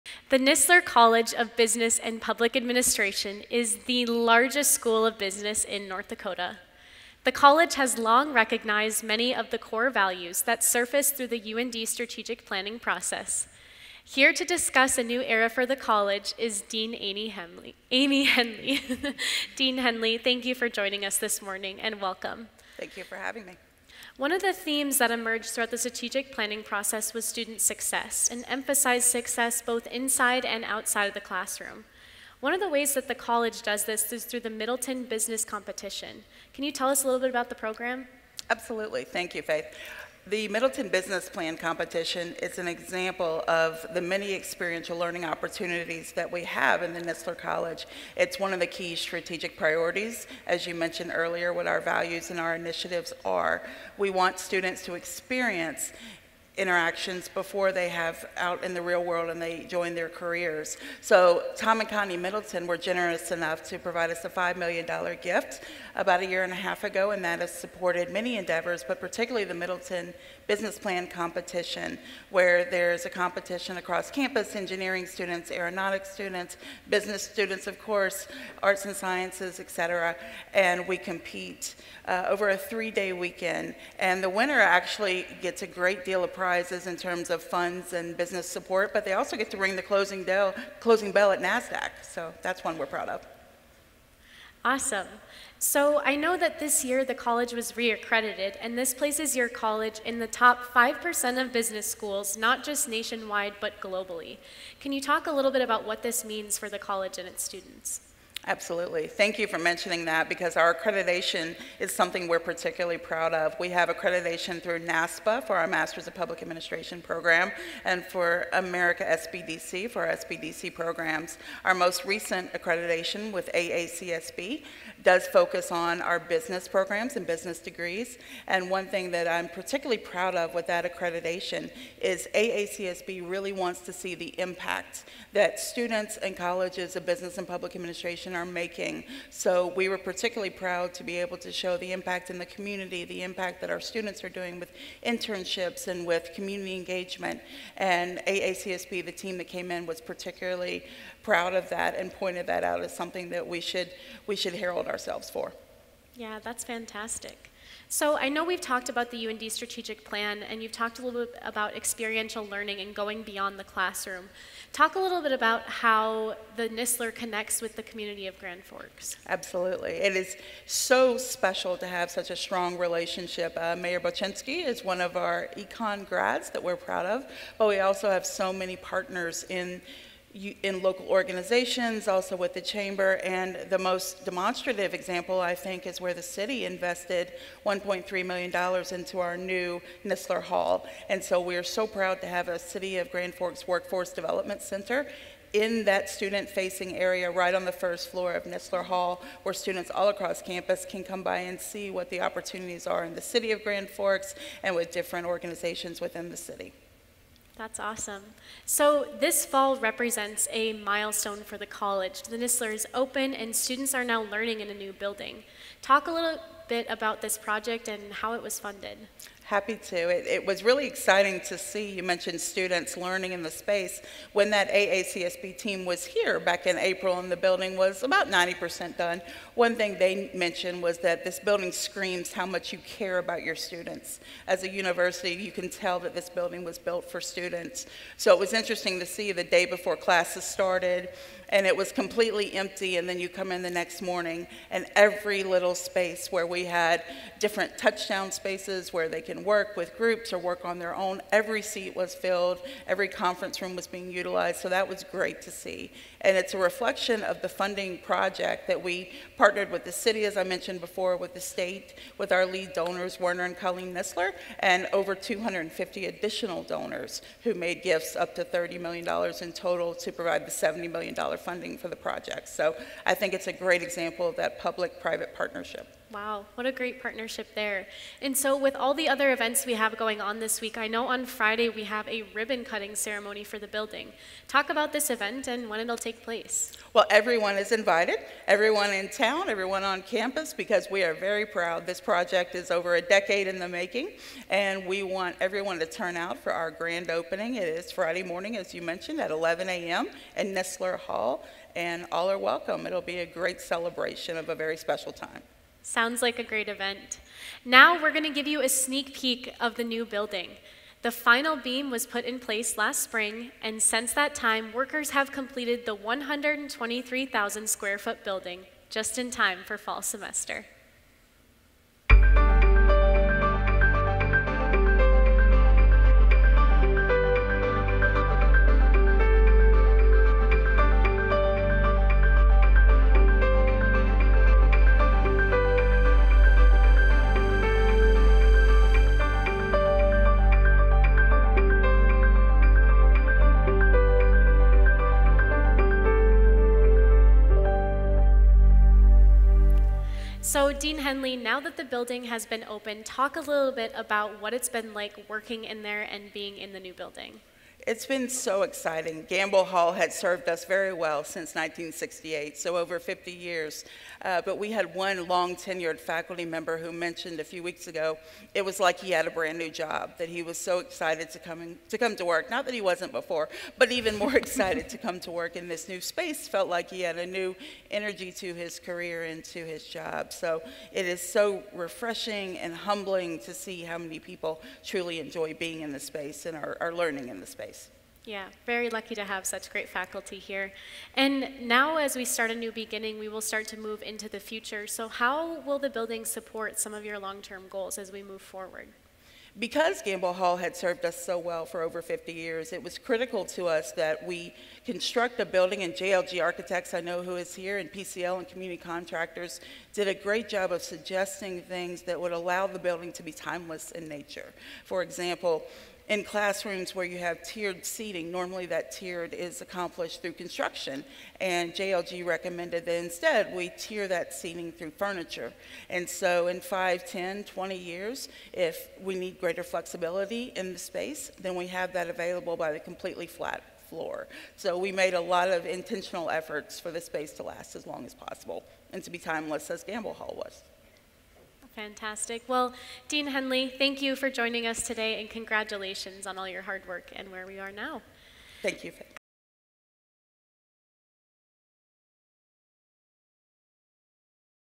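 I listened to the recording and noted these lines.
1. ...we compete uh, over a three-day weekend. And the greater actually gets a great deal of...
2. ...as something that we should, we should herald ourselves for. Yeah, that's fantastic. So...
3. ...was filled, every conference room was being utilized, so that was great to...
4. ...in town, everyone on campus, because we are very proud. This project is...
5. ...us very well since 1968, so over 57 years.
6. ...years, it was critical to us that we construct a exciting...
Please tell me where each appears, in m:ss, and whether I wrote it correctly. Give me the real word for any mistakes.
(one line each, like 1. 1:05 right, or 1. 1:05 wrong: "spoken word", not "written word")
1. 1:20 wrong: "winner", not "greater"
2. 2:32 right
3. 4:11 right
4. 4:48 right
5. 6:00 wrong: "50", not "57"
6. 6:42 wrong: "building", not "exciting".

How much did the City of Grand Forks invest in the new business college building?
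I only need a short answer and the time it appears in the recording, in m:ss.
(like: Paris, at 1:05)
$1.3 million, at 3:07.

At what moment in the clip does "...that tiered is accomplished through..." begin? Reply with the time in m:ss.
6:58.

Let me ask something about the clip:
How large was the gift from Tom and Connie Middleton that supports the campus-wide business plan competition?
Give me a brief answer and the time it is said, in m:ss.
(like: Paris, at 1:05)
$5 million, at 1:04.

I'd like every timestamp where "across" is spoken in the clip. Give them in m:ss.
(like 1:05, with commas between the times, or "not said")
1:13, 3:20.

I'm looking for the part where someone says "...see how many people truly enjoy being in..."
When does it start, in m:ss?
6:23.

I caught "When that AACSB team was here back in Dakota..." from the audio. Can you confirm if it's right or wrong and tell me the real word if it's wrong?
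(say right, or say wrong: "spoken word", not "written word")
wrong: "April", not "Dakota".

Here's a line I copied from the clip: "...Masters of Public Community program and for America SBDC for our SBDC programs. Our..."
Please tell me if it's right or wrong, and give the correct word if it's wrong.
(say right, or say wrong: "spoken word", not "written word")
wrong: "Administration", not "Community".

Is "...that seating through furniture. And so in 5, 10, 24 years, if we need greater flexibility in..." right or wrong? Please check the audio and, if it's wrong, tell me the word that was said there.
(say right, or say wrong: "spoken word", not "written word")
wrong: "20", not "24".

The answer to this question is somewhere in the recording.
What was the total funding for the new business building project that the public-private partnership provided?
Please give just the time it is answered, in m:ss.
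4:30.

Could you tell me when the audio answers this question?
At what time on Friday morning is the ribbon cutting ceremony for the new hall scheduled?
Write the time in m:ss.
4:59.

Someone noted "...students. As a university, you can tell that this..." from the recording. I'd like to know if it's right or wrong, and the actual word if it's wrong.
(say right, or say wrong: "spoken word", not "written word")
right.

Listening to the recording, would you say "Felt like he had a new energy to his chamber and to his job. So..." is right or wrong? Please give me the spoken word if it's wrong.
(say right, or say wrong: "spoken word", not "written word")
wrong: "career", not "chamber".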